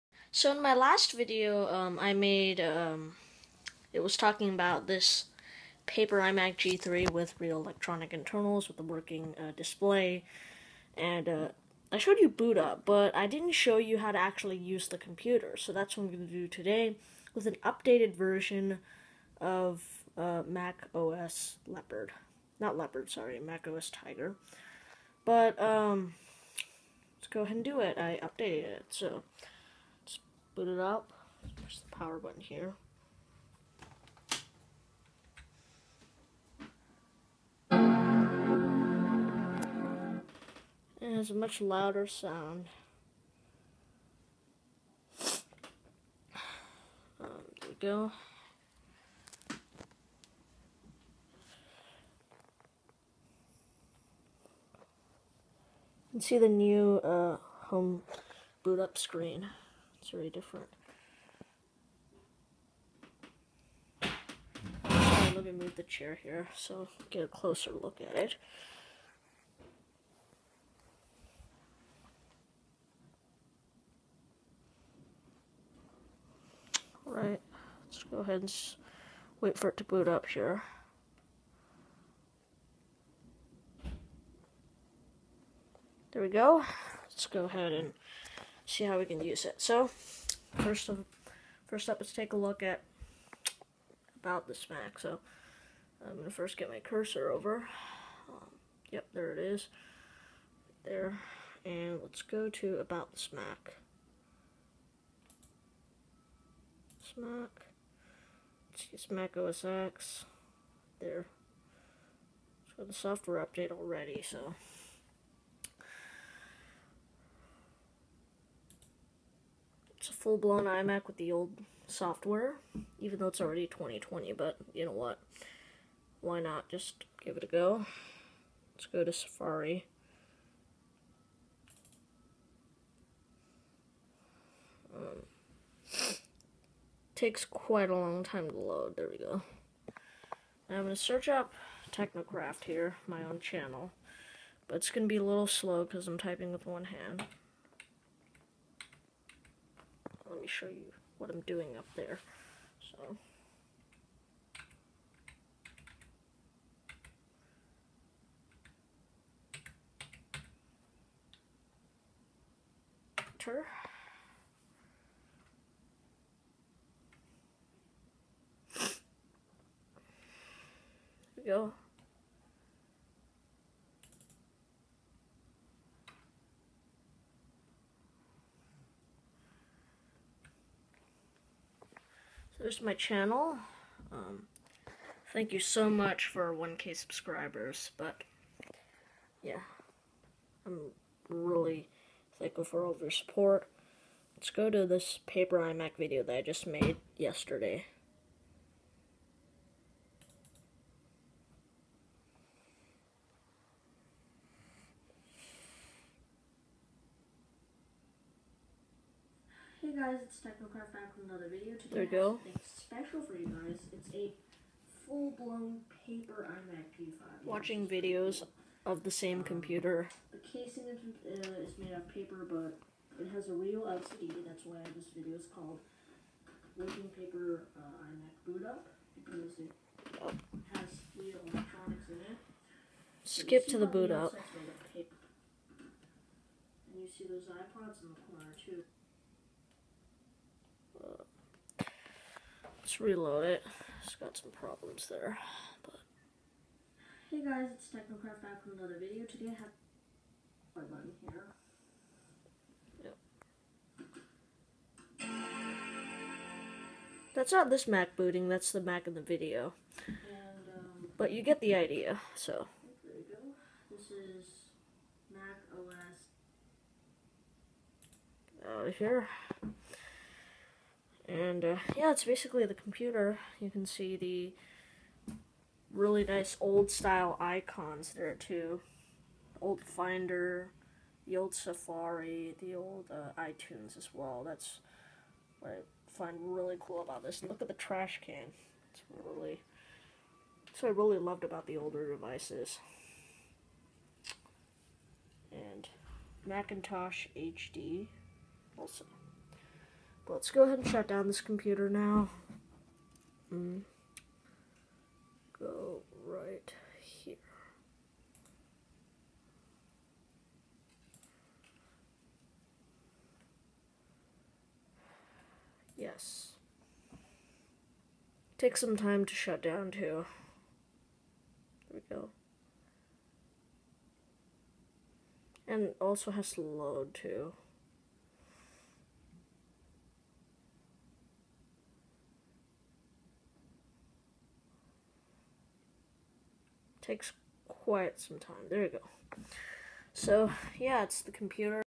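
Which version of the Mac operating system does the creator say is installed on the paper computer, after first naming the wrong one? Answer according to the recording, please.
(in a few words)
Mac OS Tiger.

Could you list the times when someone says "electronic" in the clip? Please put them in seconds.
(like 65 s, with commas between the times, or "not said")
7 s, 231 s.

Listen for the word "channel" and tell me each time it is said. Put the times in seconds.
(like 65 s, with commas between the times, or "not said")
143 s, 182 s.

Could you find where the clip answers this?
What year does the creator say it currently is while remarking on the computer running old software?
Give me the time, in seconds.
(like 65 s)
123 s.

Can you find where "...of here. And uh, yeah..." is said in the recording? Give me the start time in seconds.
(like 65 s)
268 s.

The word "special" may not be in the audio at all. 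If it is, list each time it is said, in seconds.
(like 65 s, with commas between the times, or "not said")
212 s.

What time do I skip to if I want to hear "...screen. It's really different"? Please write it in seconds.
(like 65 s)
58 s.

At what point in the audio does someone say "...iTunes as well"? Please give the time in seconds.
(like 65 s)
283 s.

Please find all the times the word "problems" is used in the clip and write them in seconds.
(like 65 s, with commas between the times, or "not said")
244 s.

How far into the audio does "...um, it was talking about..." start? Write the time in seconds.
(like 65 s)
2 s.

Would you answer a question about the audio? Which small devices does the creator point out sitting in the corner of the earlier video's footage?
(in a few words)
iPods.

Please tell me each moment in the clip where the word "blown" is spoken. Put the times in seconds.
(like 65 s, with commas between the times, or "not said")
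120 s, 215 s.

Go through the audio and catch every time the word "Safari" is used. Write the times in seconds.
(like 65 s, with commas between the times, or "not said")
129 s, 281 s.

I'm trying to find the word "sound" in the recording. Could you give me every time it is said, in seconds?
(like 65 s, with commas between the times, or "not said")
42 s.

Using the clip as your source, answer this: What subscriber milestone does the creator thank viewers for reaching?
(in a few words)
1k.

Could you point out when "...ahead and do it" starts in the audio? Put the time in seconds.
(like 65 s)
27 s.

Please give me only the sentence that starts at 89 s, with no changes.
So, first of, first up, let's take a look at about this Mac.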